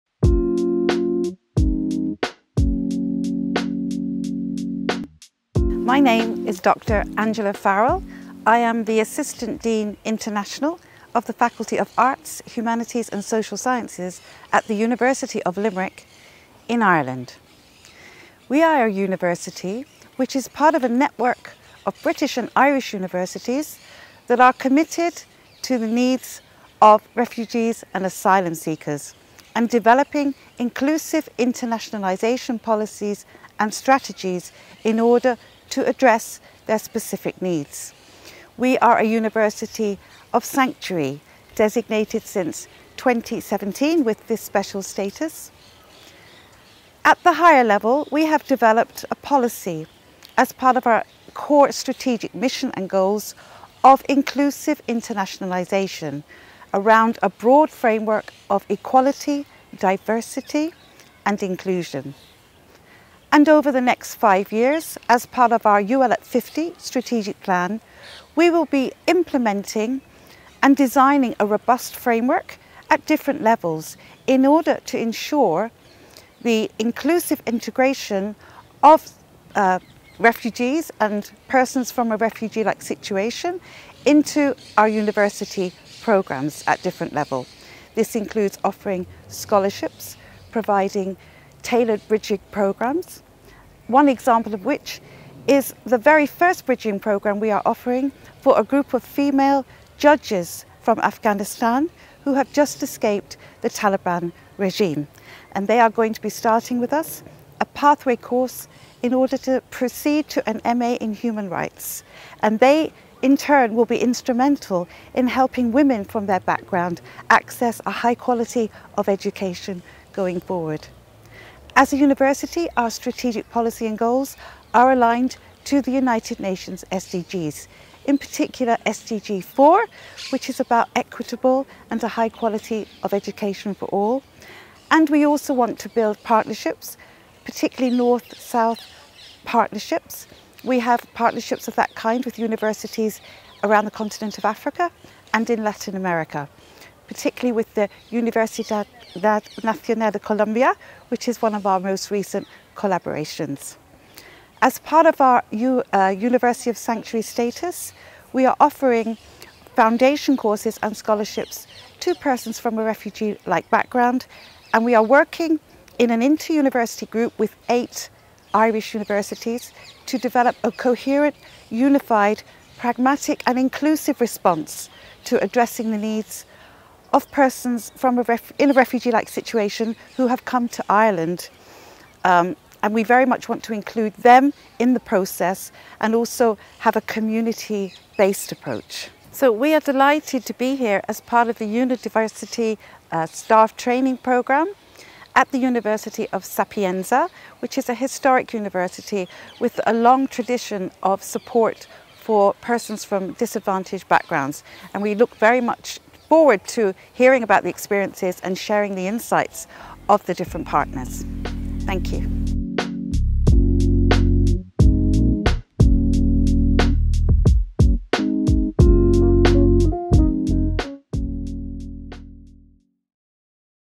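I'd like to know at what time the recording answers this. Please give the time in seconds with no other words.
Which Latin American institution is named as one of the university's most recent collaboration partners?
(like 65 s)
148 s.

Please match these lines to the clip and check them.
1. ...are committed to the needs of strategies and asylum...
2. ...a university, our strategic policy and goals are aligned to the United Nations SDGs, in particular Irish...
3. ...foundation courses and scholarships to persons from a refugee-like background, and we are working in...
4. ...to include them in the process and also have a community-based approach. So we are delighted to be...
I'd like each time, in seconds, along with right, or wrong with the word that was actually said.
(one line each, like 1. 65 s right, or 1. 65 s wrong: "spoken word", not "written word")
1. 24 s wrong: "refugees", not "strategies"
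2. 121 s wrong: "SDG", not "Irish"
3. 159 s right
4. 183 s right.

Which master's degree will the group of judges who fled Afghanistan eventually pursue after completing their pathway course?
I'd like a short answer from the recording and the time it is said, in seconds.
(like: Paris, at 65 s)
MA in human rights, at 110 s.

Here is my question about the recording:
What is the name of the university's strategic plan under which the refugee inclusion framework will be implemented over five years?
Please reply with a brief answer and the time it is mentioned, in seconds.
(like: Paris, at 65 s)
UL at 50, at 65 s.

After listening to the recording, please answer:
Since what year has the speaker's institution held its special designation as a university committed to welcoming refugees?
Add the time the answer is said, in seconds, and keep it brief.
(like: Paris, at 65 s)
2017, at 42 s.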